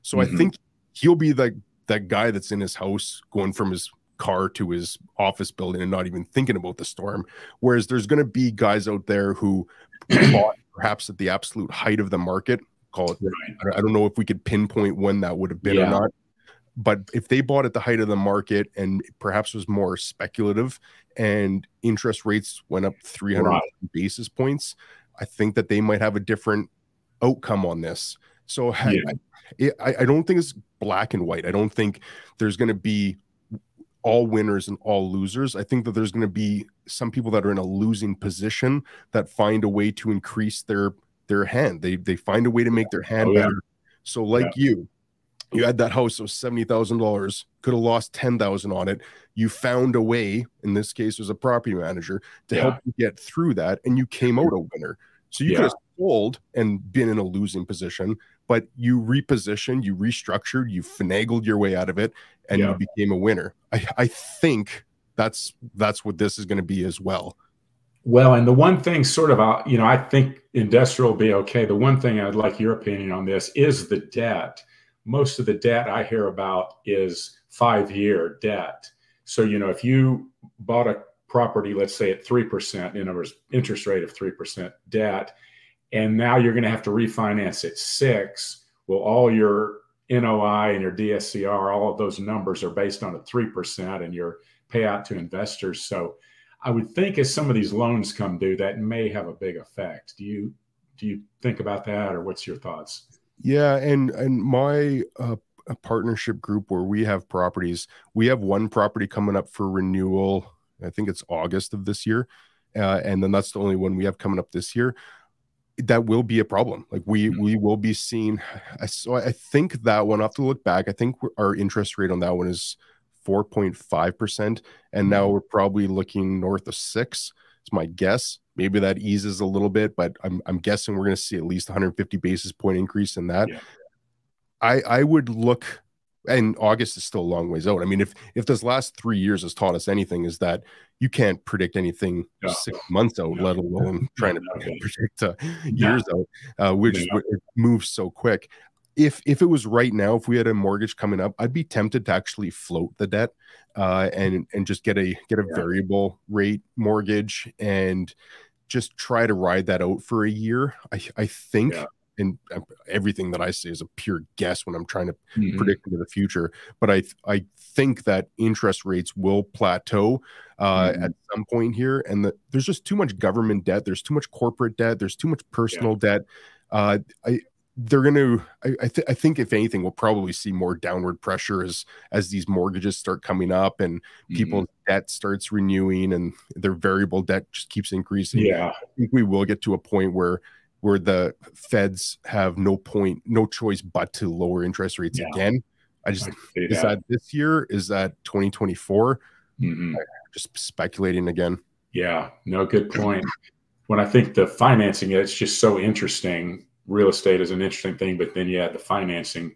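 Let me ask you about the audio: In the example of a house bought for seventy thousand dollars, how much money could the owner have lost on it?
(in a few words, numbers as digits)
$10,000.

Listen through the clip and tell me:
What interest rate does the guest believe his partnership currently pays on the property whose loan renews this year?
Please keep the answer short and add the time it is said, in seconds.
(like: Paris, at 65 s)
4.5%, at 123 s.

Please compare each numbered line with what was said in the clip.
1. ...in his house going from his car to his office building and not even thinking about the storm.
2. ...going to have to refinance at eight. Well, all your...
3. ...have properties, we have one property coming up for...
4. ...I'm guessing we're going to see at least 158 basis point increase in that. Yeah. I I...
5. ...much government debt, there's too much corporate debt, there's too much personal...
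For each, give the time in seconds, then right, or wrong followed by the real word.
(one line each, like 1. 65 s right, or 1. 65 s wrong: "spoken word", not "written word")
1. 2 s right
2. 86 s wrong: "six", not "eight"
3. 107 s right
4. 130 s wrong: "150", not "158"
5. 172 s right.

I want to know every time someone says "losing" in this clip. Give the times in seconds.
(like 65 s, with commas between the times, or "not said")
37 s, 57 s.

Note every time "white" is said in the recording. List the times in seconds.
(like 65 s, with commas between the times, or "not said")
31 s.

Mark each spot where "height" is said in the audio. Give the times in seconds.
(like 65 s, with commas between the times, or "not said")
11 s, 17 s.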